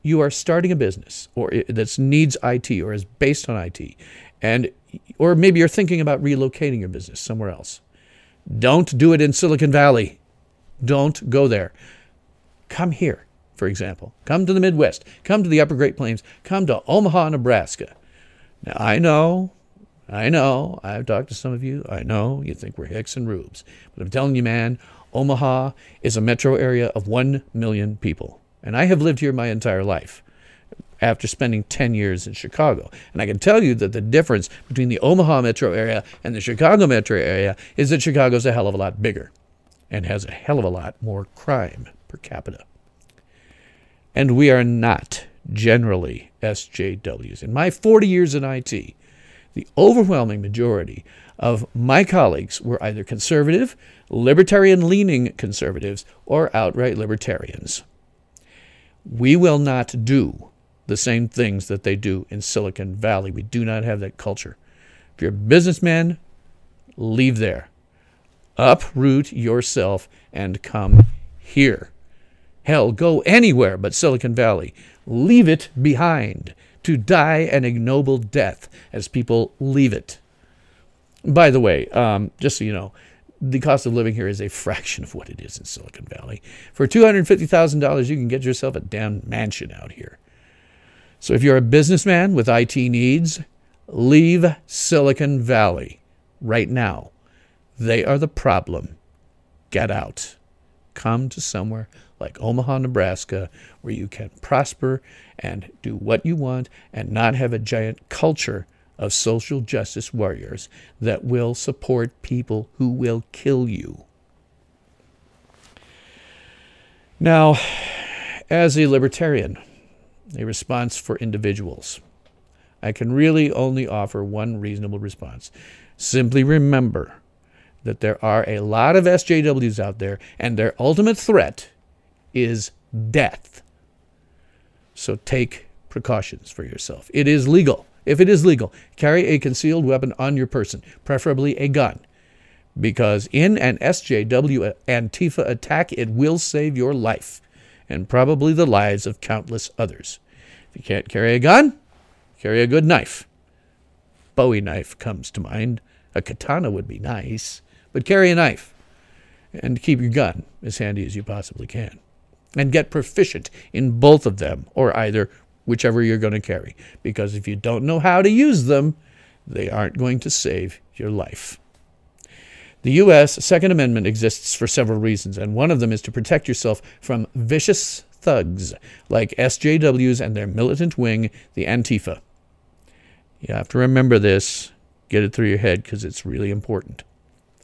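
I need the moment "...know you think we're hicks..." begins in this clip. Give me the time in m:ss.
0:22.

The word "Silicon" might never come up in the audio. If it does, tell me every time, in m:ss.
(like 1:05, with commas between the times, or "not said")
0:09, 1:02, 1:13, 1:25, 1:34.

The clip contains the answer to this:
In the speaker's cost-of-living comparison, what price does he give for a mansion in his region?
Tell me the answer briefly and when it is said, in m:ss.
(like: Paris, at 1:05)
$250,000, at 1:26.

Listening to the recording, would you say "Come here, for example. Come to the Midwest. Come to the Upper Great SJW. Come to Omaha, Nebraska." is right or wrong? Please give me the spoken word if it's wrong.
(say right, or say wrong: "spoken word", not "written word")
wrong: "Plains", not "SJW".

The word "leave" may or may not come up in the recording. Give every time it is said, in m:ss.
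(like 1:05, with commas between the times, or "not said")
1:06, 1:15, 1:19, 1:33.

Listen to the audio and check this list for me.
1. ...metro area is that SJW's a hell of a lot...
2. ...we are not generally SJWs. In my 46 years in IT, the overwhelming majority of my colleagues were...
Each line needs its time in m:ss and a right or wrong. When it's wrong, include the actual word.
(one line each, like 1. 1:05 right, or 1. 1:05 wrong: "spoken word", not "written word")
1. 0:36 wrong: "Chicago", not "SJW"
2. 0:44 wrong: "40", not "46".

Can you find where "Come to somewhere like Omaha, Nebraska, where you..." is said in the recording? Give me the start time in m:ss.
1:40.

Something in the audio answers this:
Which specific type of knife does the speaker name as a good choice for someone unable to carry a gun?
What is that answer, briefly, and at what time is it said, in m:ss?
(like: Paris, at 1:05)
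Bowie knife, at 2:34.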